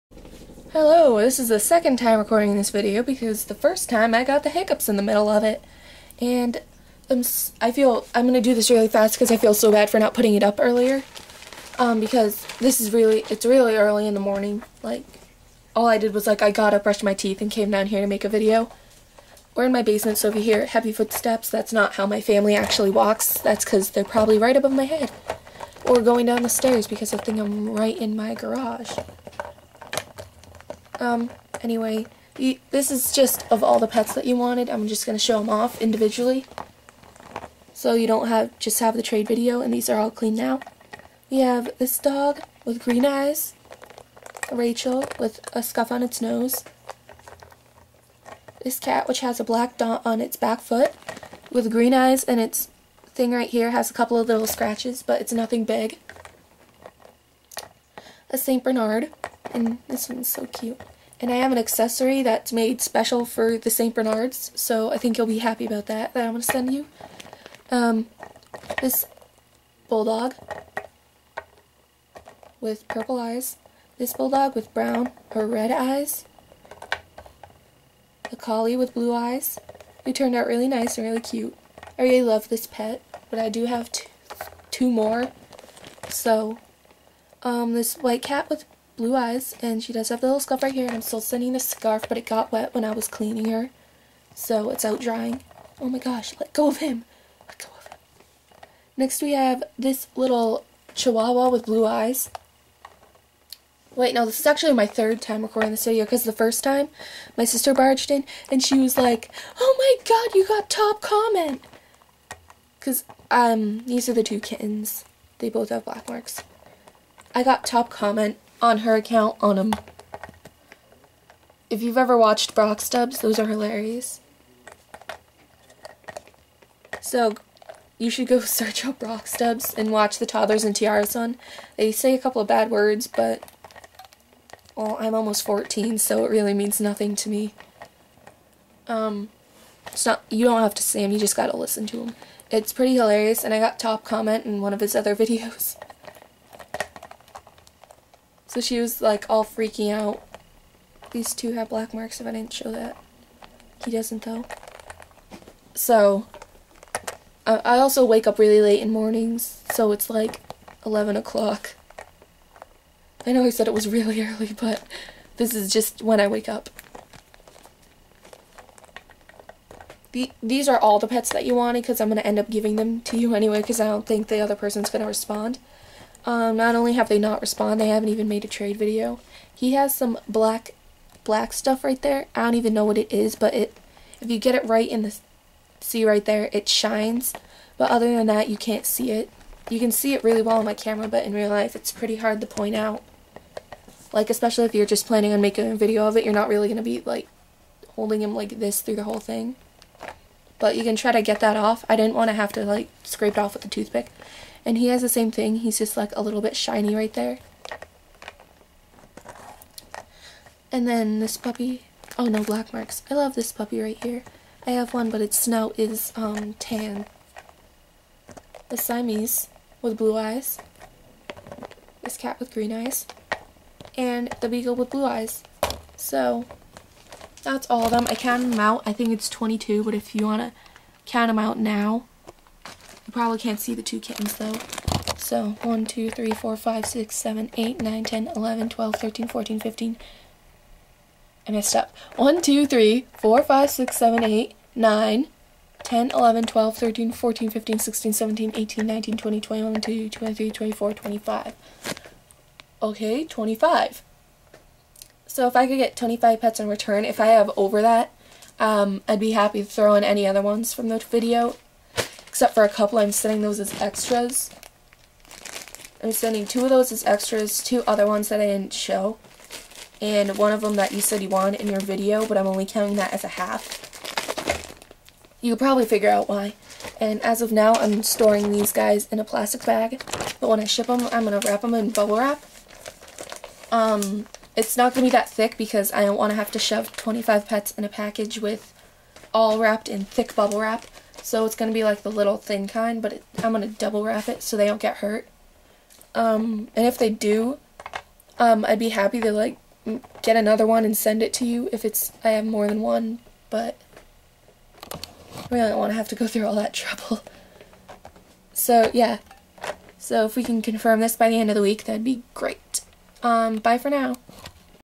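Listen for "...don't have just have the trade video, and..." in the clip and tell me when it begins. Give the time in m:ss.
0:38.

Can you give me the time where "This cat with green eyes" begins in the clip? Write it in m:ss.
3:42.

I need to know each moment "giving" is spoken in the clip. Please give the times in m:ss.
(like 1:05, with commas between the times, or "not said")
2:52.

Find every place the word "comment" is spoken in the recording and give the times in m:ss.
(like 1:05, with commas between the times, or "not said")
1:51, 1:57, 2:24.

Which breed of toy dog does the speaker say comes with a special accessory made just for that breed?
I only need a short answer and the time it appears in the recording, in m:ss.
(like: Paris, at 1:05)
St. Bernard, at 0:58.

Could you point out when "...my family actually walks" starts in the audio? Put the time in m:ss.
0:22.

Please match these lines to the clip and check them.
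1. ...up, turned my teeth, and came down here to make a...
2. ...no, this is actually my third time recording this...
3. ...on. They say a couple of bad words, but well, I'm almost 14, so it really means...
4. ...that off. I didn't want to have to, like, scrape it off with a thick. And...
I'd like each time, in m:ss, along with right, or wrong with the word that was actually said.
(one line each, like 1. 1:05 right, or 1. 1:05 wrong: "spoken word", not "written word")
1. 0:16 wrong: "brushed", not "turned"
2. 1:44 right
3. 2:11 right
4. 3:21 wrong: "toothpick", not "thick".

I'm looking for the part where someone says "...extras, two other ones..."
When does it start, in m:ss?
4:27.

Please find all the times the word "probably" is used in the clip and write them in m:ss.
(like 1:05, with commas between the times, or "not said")
0:24, 4:35.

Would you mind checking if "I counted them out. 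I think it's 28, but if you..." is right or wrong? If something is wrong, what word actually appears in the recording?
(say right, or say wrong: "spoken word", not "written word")
wrong: "22", not "28".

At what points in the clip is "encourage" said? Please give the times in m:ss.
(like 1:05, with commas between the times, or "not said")
not said.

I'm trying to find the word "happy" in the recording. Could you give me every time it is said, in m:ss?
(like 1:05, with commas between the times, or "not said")
1:05, 4:58.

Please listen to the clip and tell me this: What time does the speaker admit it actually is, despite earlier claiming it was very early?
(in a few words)
11 o'clock.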